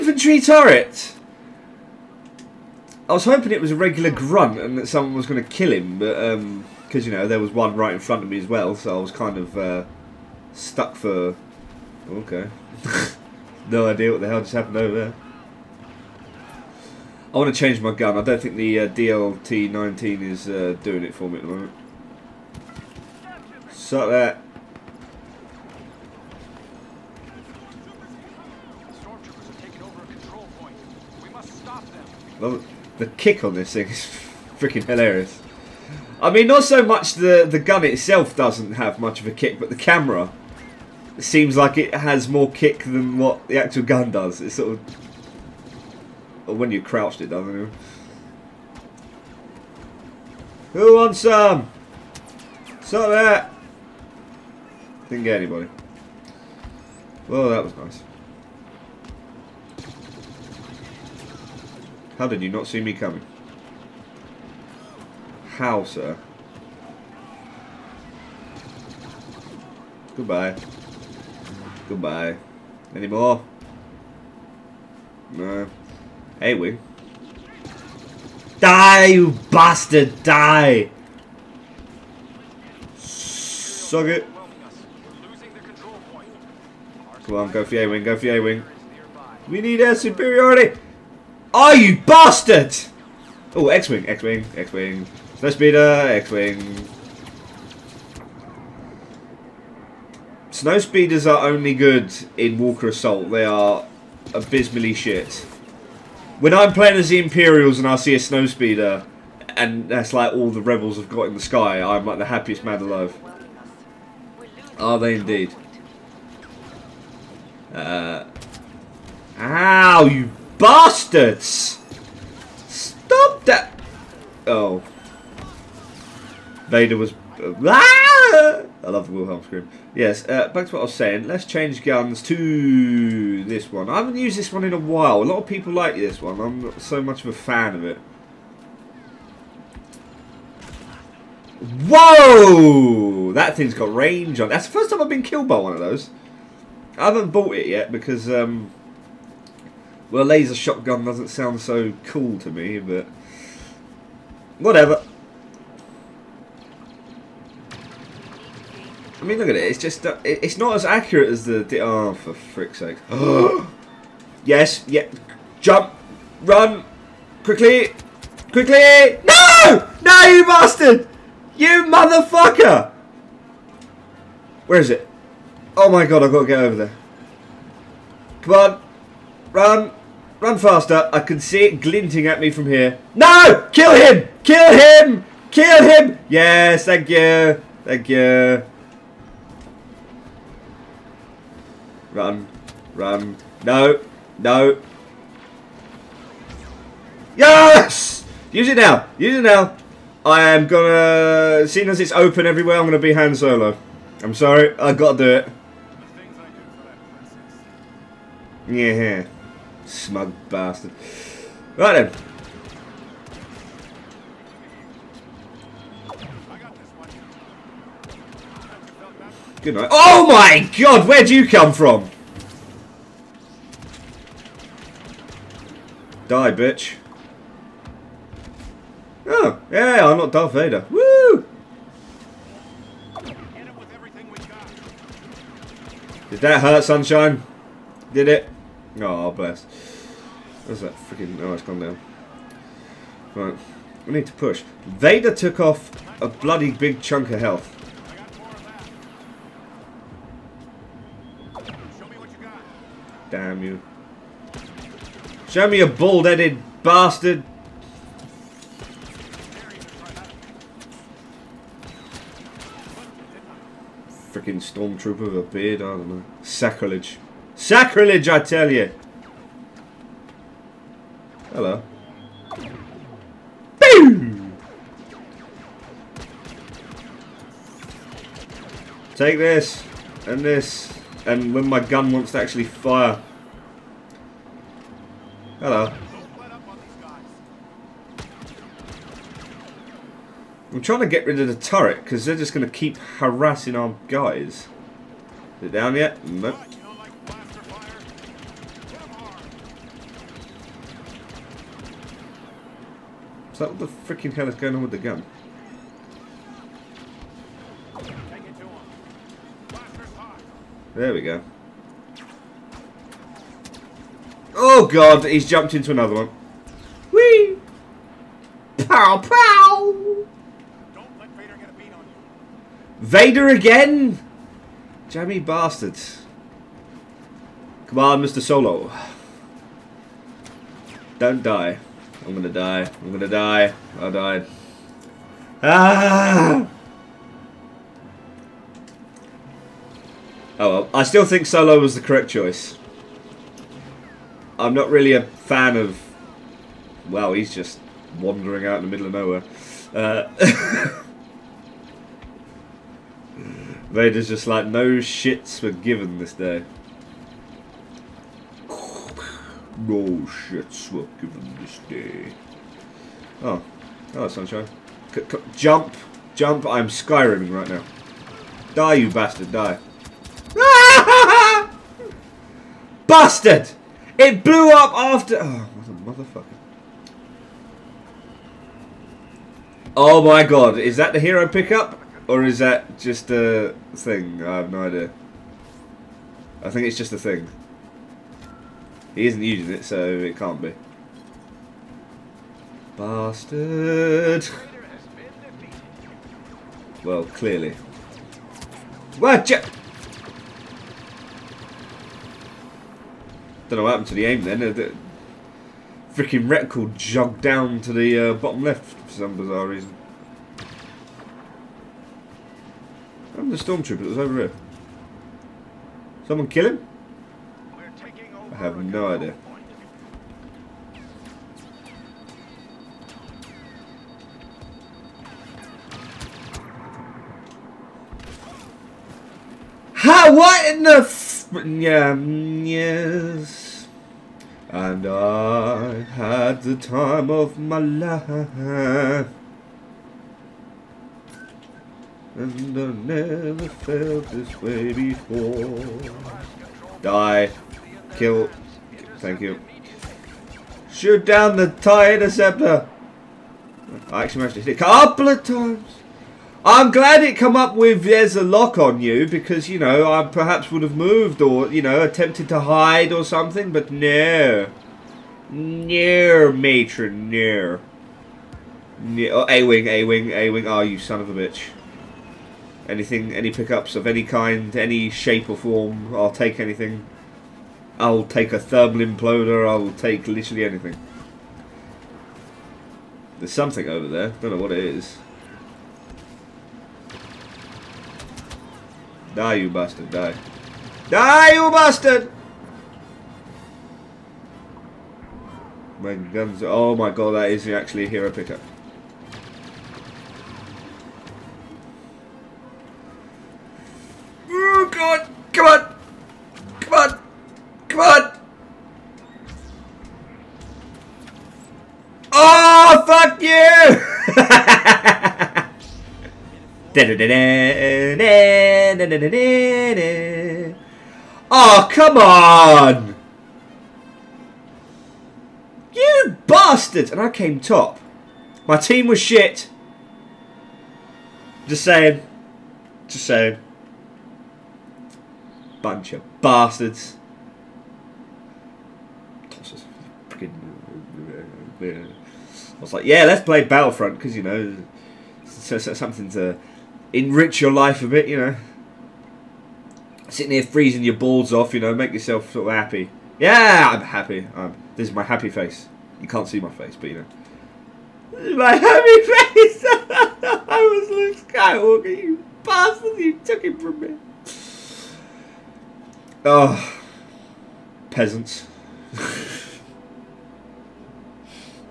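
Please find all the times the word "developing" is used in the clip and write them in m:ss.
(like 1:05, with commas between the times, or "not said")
not said.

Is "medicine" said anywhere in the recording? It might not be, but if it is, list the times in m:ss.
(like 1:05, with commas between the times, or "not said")
not said.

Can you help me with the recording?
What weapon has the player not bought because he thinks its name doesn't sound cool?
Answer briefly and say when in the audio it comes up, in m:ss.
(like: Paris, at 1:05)
laser shotgun, at 2:30.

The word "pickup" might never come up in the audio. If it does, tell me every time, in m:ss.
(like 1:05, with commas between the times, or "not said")
6:21, 7:53, 8:18.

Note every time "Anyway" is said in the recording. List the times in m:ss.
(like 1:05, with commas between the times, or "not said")
1:16.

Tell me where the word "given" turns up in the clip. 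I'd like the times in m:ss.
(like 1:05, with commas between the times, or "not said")
5:55, 6:01.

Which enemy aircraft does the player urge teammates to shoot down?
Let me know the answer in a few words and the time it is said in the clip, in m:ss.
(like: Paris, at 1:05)
TIE Interceptor, at 7:31.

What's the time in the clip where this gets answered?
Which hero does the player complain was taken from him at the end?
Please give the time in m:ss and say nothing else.
9:21.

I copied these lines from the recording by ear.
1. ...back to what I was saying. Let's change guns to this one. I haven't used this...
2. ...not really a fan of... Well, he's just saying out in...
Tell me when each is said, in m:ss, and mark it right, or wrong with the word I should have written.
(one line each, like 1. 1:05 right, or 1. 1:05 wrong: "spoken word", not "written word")
1. 2:10 right
2. 5:44 wrong: "wandering", not "saying".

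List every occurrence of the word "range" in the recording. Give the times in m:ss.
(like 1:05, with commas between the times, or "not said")
2:23.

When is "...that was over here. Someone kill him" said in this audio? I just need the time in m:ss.
6:53.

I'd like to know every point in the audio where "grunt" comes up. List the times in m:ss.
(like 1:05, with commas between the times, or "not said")
0:04.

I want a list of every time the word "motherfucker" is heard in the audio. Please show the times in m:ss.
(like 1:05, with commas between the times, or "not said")
2:51, 6:16.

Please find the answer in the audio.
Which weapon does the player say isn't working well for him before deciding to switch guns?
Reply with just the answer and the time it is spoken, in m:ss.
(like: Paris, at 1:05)
DLT-19, at 0:18.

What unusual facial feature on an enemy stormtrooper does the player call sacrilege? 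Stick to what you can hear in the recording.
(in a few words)
a beard.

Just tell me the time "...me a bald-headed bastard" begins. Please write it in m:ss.
4:15.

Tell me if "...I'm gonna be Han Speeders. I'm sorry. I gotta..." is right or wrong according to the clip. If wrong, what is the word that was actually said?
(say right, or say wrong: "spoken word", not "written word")
wrong: "Solo", not "Speeders".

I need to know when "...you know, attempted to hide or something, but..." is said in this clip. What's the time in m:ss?
7:41.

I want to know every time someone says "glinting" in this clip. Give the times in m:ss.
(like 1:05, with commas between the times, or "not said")
3:01.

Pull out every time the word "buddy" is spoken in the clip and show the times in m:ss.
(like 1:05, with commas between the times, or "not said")
not said.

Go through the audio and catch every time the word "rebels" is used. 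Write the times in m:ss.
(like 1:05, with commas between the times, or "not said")
1:50.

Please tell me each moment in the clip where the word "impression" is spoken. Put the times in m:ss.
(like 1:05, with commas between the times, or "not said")
not said.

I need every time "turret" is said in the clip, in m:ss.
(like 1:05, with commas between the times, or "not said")
0:00, 4:51.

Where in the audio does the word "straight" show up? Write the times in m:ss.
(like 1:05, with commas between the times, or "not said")
not said.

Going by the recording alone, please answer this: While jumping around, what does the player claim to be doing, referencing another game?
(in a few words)
Skyriming.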